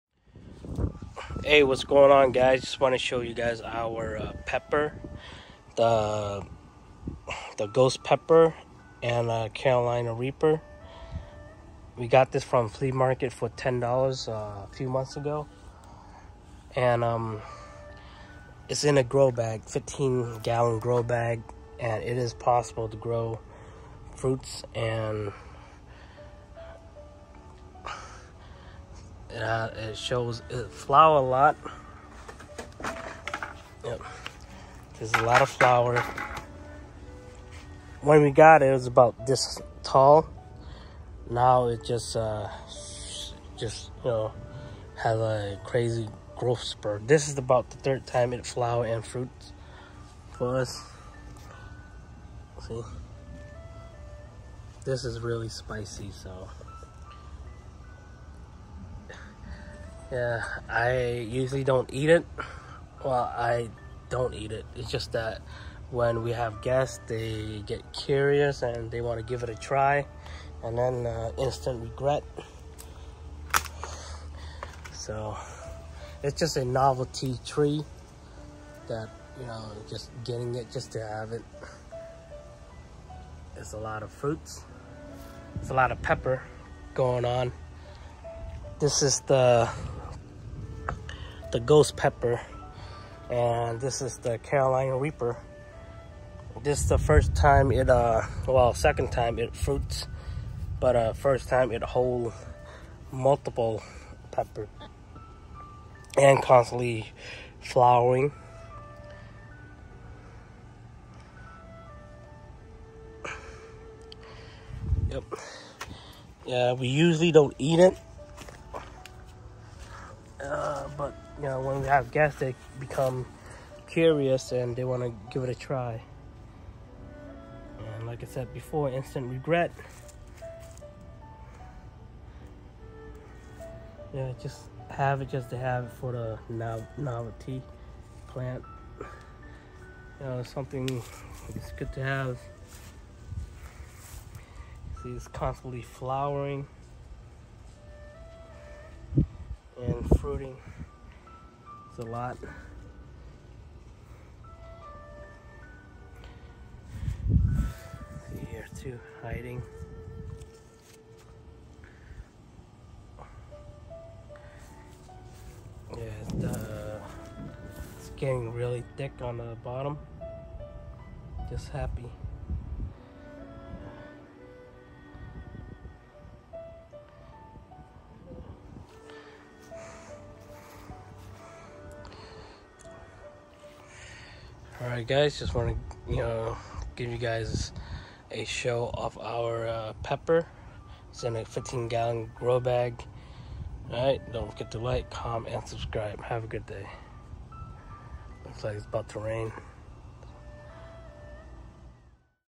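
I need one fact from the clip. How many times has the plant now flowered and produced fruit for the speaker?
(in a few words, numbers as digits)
3rd time.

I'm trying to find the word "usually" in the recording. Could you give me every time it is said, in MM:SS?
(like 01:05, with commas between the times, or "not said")
01:01, 01:56.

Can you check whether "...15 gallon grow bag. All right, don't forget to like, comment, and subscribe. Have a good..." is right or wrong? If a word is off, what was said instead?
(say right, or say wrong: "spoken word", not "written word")
right.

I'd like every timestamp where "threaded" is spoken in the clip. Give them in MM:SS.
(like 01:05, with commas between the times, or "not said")
not said.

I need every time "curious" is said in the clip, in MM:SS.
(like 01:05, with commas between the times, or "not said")
01:07, 02:03.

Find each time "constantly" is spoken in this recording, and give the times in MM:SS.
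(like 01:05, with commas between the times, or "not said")
01:46, 02:25.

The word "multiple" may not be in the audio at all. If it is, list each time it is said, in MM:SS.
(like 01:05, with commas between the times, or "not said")
01:43.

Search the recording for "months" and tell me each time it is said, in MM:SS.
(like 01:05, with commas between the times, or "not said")
00:14.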